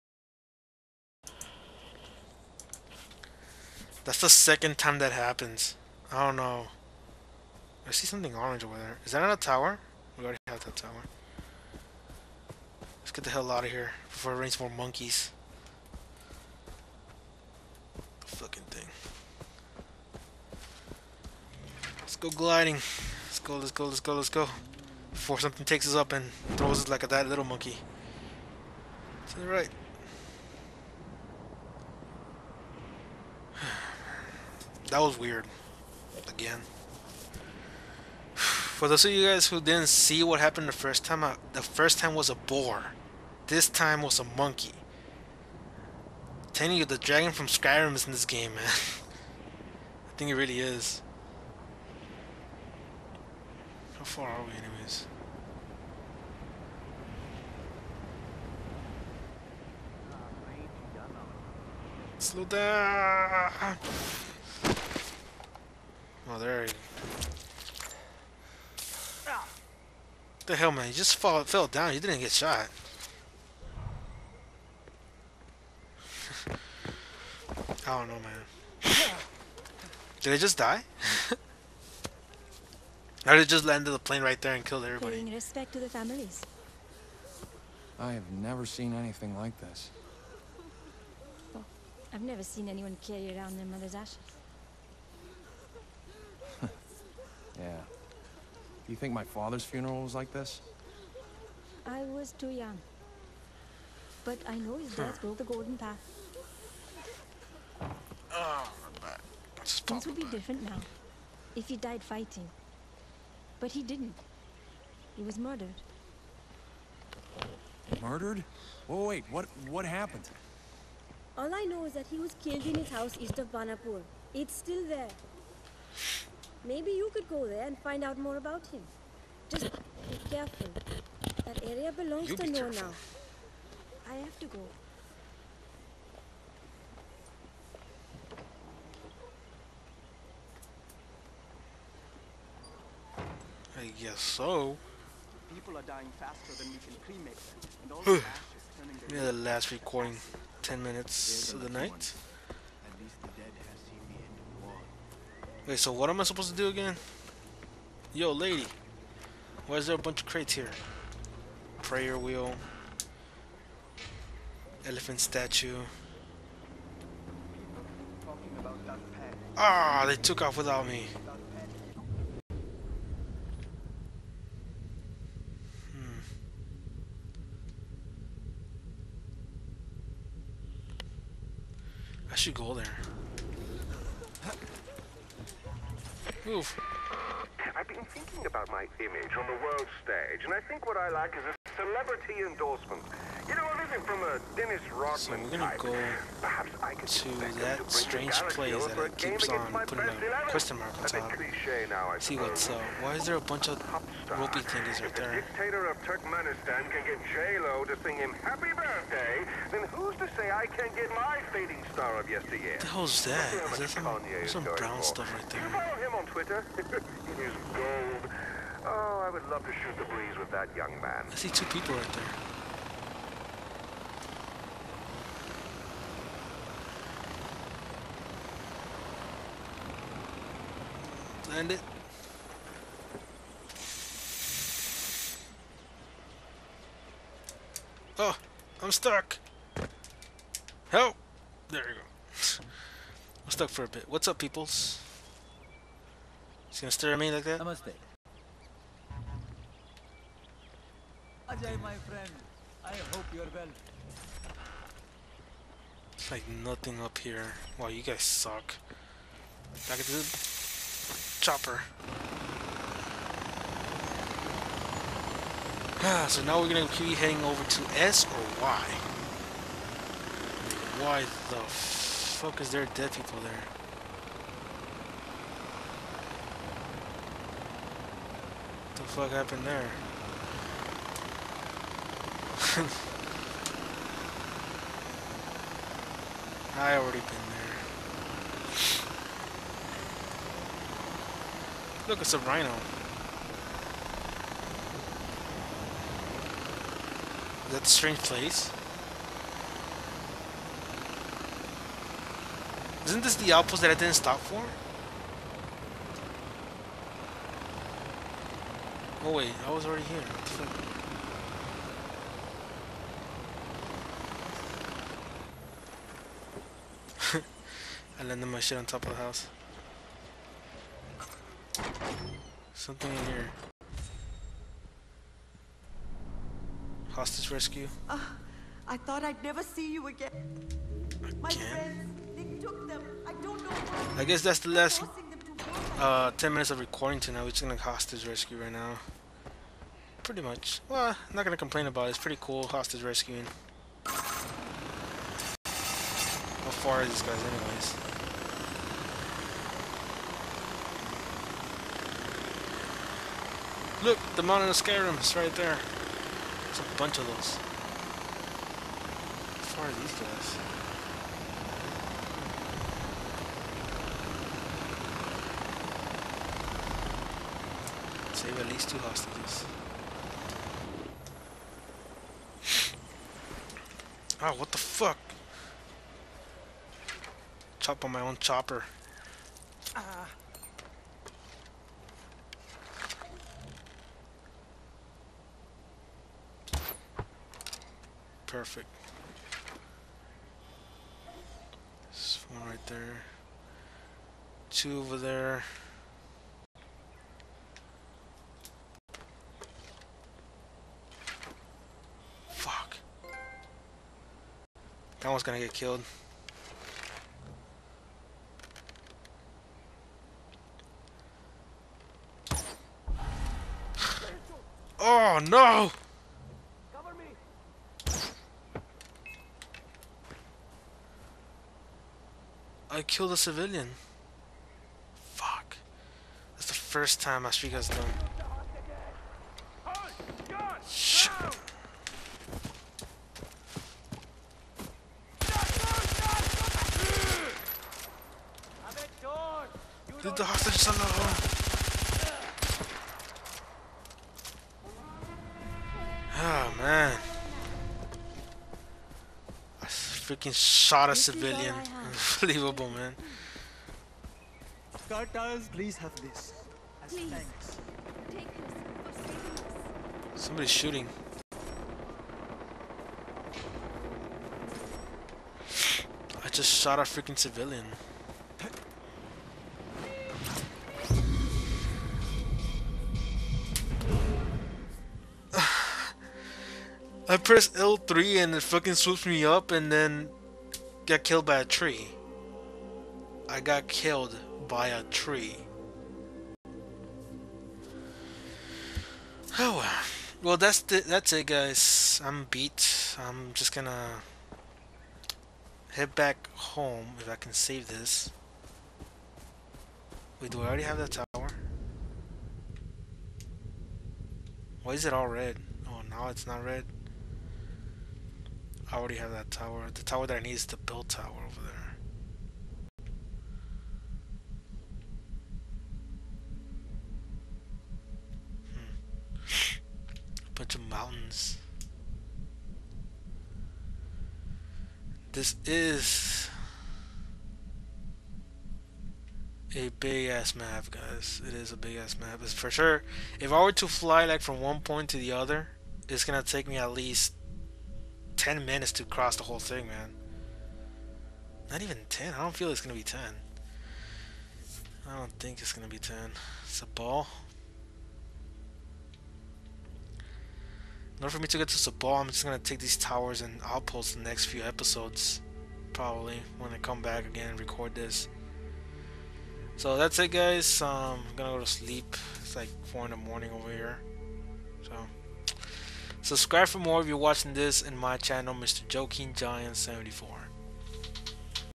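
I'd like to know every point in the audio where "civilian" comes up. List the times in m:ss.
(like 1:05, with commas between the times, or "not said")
7:03, 7:31, 7:47.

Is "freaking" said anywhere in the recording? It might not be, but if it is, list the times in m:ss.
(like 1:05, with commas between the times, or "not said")
7:30, 7:47.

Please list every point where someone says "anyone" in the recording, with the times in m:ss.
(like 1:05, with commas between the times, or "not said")
1:32.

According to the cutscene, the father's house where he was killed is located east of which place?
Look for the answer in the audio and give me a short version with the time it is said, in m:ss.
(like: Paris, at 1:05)
Banapur, at 2:03.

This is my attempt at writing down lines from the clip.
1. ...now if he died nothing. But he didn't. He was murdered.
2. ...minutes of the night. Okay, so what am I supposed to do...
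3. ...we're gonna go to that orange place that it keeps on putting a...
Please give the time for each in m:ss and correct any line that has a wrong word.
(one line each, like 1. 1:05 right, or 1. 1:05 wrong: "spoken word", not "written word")
1. 1:50 wrong: "fighting", not "nothing"
2. 2:30 right
3. 3:15 wrong: "strange", not "orange".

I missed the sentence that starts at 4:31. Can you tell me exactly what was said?
Why the fuck is there dead people there?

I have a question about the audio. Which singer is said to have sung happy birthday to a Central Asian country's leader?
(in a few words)
J-Lo.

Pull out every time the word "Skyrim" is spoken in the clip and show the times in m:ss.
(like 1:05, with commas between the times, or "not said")
0:47, 5:54.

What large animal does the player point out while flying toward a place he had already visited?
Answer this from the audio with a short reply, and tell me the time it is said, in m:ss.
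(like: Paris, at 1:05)
Rhino, at 4:52.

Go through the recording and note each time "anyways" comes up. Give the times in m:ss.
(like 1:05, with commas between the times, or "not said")
0:54, 5:47.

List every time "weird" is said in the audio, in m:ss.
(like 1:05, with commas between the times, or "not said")
0:35.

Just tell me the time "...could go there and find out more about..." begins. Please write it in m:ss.
2:07.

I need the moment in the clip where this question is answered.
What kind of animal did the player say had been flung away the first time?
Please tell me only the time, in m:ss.
0:42.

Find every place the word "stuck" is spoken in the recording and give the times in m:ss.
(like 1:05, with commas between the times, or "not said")
3:58, 4:03.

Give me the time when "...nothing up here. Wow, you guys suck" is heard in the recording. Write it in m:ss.
4:16.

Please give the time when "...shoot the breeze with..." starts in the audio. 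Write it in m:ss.
3:39.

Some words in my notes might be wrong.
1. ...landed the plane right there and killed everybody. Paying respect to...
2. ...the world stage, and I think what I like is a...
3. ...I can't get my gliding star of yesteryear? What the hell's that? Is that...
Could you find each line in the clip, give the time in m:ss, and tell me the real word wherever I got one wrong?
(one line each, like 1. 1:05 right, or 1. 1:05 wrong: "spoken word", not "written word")
1. 1:23 right
2. 3:09 right
3. 3:30 wrong: "fading", not "gliding".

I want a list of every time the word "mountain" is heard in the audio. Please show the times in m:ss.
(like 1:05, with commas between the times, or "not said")
5:54, 8:40.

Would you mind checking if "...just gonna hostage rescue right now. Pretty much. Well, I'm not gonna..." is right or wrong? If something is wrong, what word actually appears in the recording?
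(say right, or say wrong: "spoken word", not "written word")
right.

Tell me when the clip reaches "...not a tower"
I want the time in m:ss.
0:09.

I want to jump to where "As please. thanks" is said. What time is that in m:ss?
7:37.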